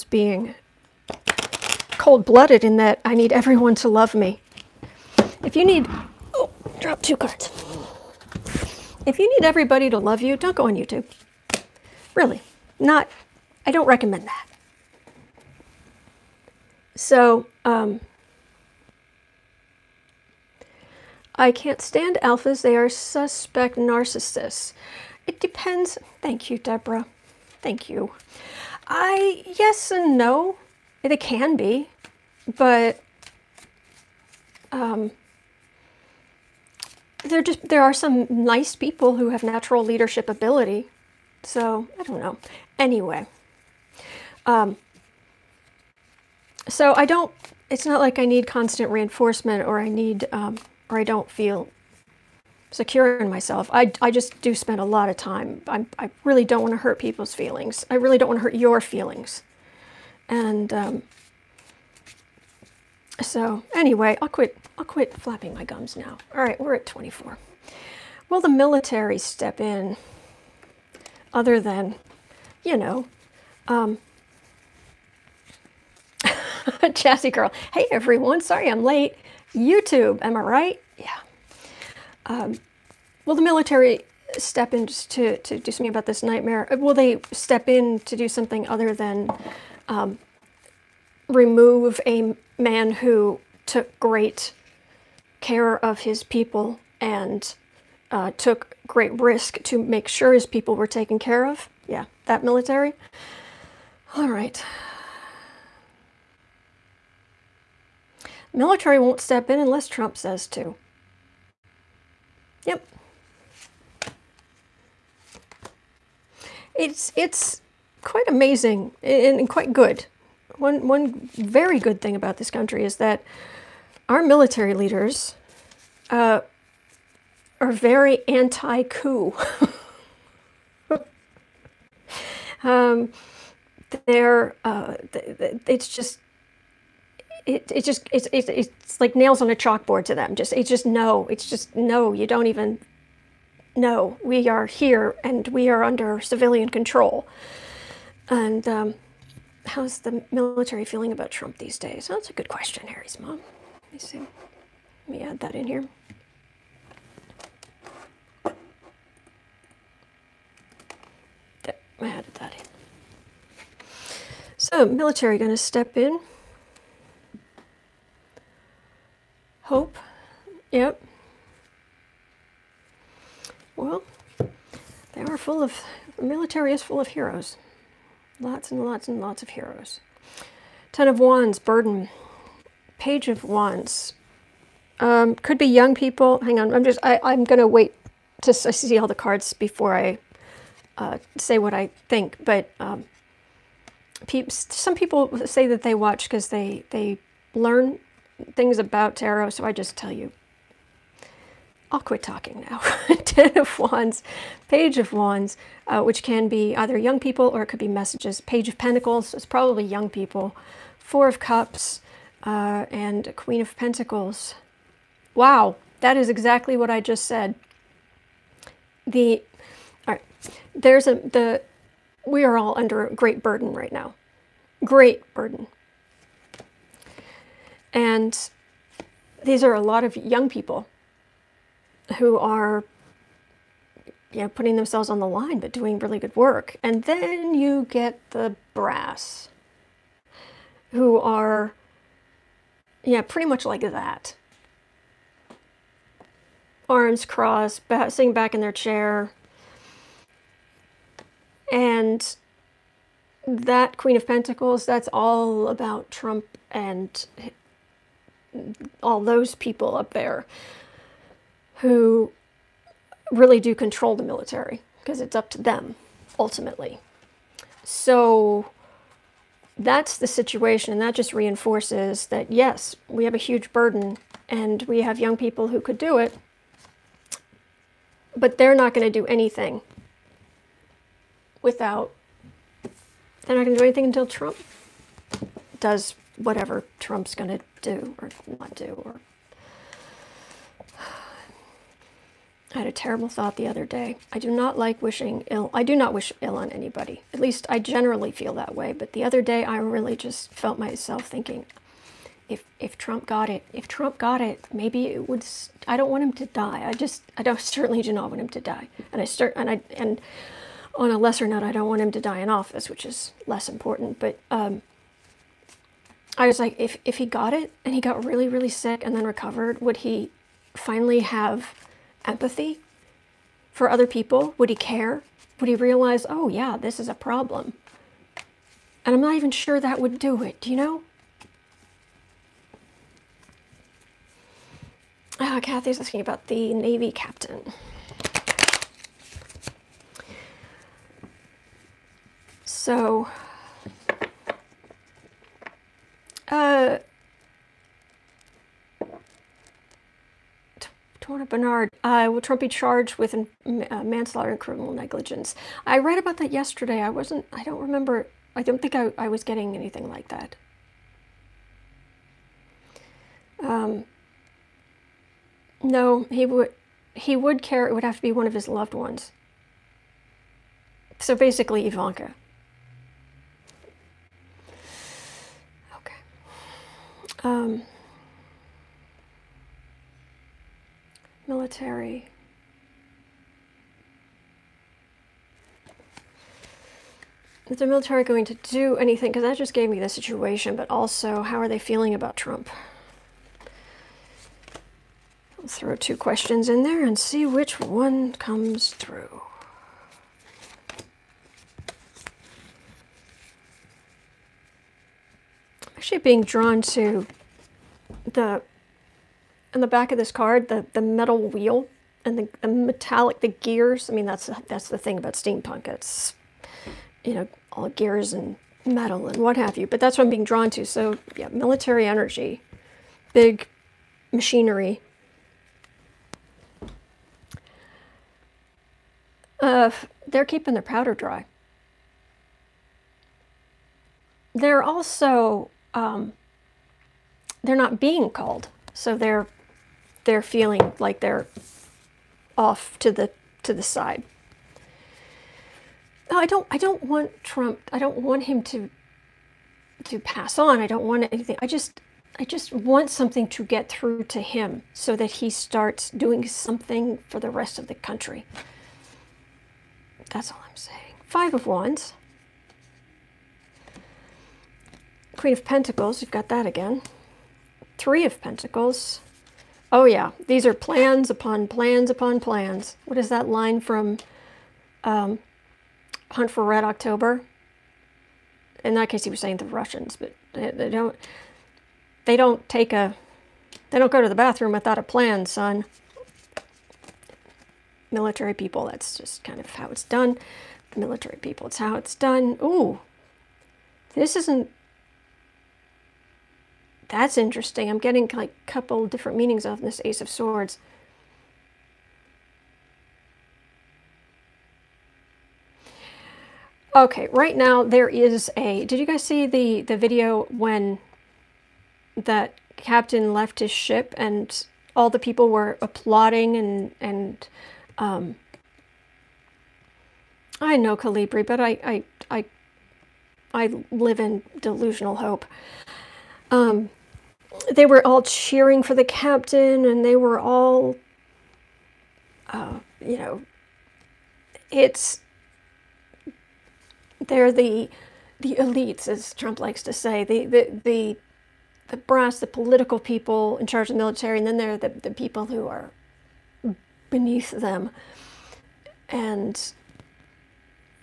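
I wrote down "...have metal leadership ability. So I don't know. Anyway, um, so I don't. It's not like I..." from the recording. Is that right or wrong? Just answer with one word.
wrong.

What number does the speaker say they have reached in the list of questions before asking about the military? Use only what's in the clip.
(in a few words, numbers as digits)
24.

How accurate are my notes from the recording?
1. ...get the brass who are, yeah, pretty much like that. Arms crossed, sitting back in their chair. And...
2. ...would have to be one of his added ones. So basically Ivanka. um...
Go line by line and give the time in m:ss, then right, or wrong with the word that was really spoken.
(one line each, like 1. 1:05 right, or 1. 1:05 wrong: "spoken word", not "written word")
1. 3:57 right
2. 6:07 wrong: "loved", not "added".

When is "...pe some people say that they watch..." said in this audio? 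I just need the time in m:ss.
3:14.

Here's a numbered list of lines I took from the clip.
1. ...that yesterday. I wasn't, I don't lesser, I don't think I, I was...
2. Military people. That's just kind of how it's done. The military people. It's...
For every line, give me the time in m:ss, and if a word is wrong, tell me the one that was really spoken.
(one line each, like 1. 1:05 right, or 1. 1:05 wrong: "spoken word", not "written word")
1. 5:56 wrong: "remember", not "lesser"
2. 8:08 right.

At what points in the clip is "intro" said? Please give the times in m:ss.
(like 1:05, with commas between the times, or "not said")
not said.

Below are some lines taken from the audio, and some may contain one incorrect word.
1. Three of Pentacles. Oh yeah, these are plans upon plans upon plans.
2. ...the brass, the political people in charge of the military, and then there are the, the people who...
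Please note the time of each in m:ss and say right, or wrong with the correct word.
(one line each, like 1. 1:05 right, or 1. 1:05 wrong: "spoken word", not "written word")
1. 7:47 right
2. 9:01 right.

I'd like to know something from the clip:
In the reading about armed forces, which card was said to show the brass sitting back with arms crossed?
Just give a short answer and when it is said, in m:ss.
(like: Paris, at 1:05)
Four of Cups, at 3:30.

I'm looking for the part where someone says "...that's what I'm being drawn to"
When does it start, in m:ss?
6:59.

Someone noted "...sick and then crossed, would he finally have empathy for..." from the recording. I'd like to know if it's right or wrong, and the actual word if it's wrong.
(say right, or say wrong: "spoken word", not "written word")
wrong: "recovered", not "crossed".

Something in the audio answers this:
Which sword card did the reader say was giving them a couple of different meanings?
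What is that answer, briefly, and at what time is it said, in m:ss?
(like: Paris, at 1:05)
Ace of Swords, at 8:20.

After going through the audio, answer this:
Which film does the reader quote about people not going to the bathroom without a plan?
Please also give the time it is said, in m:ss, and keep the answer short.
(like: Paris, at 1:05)
Hunt for Red October, at 7:56.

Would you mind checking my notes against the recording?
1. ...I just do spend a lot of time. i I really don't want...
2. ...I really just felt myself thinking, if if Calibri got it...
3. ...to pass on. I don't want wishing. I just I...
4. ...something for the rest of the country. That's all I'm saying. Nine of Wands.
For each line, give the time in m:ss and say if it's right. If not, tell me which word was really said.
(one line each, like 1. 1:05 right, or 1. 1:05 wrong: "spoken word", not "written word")
1. 0:54 right
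2. 4:59 wrong: "Trump", not "Calibri"
3. 7:30 wrong: "anything", not "wishing"
4. 7:36 wrong: "Five", not "Nine".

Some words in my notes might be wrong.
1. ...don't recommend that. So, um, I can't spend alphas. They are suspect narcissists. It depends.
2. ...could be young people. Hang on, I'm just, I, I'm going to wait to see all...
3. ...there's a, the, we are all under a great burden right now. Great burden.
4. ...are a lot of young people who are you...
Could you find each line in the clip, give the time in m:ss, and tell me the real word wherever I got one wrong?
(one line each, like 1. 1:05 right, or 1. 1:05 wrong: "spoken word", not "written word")
1. 0:13 wrong: "stand", not "spend"
2. 3:05 right
3. 3:40 right
4. 3:49 right.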